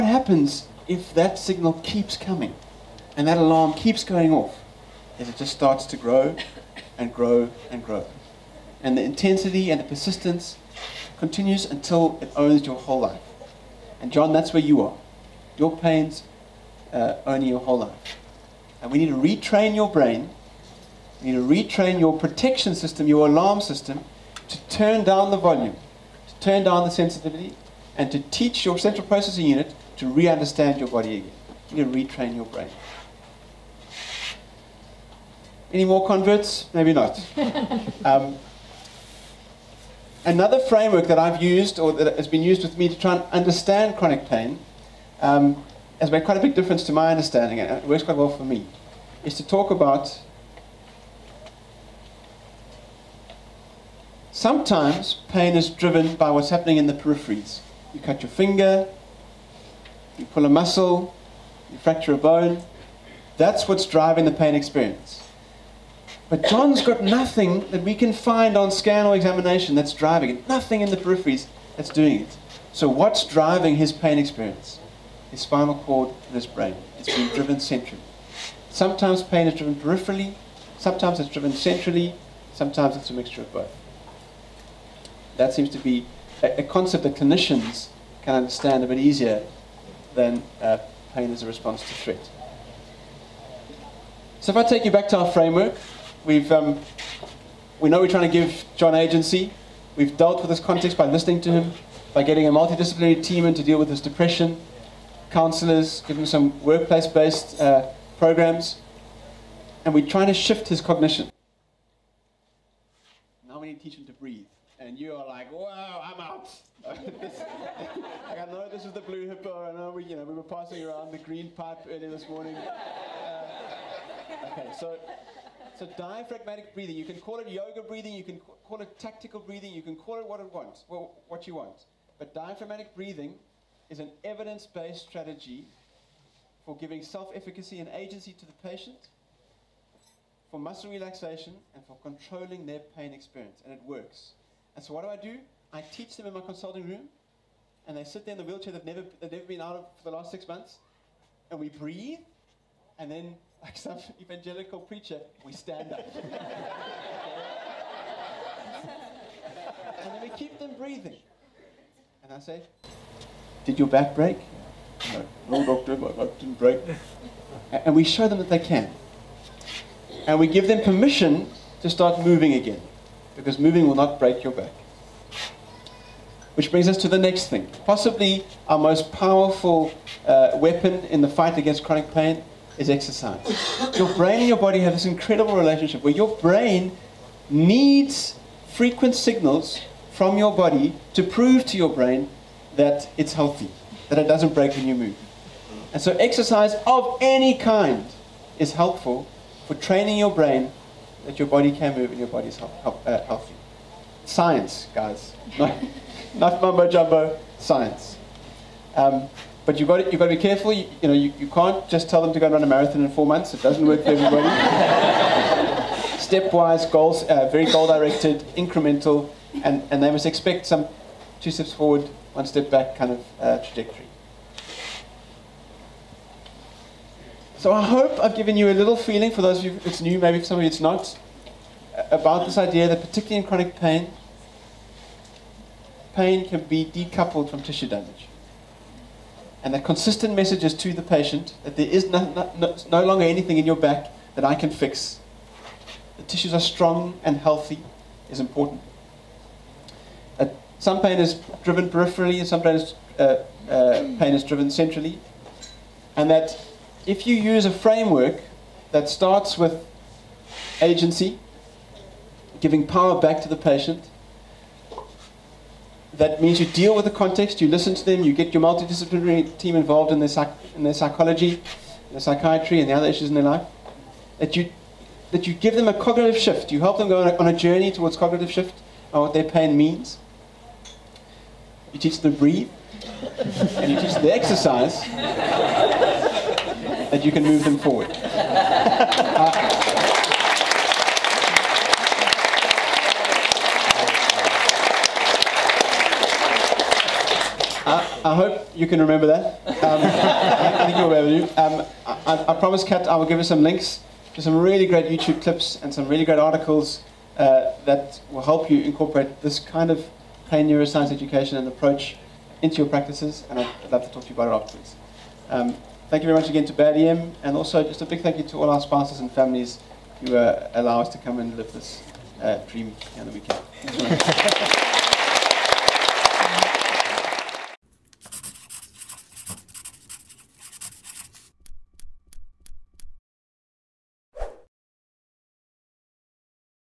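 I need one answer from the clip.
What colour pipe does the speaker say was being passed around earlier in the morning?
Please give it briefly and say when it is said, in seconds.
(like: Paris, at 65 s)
Green, at 121 s.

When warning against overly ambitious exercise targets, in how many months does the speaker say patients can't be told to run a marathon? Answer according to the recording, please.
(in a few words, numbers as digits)
4.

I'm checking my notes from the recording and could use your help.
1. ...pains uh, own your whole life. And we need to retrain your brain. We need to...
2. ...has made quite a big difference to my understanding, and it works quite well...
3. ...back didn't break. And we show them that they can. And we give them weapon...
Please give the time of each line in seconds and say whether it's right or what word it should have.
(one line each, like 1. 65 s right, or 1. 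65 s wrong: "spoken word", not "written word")
1. 15 s right
2. 46 s right
3. 166 s wrong: "permission", not "weapon".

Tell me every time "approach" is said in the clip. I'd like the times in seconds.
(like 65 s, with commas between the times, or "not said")
311 s.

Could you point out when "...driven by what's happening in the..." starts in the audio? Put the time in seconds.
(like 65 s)
55 s.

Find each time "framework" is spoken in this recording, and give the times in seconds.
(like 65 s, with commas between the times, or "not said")
40 s, 95 s, 257 s.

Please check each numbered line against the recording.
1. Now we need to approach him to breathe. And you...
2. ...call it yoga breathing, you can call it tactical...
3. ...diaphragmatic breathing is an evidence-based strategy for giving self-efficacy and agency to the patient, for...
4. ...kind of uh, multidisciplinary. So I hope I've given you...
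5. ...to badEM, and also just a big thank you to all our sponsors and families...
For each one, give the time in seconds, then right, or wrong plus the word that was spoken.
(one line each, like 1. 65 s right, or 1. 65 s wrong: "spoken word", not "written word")
1. 113 s wrong: "teach", not "approach"
2. 127 s right
3. 132 s right
4. 222 s wrong: "trajectory", not "multidisciplinary"
5. 316 s right.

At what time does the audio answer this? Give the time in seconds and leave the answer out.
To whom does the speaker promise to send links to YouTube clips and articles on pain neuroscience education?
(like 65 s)
302 s.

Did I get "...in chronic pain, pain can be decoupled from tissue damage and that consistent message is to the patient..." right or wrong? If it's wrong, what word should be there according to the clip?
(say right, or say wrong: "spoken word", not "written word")
right.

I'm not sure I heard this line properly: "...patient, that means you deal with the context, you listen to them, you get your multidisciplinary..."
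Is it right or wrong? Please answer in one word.
right.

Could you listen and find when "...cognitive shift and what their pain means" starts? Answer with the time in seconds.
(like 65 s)
278 s.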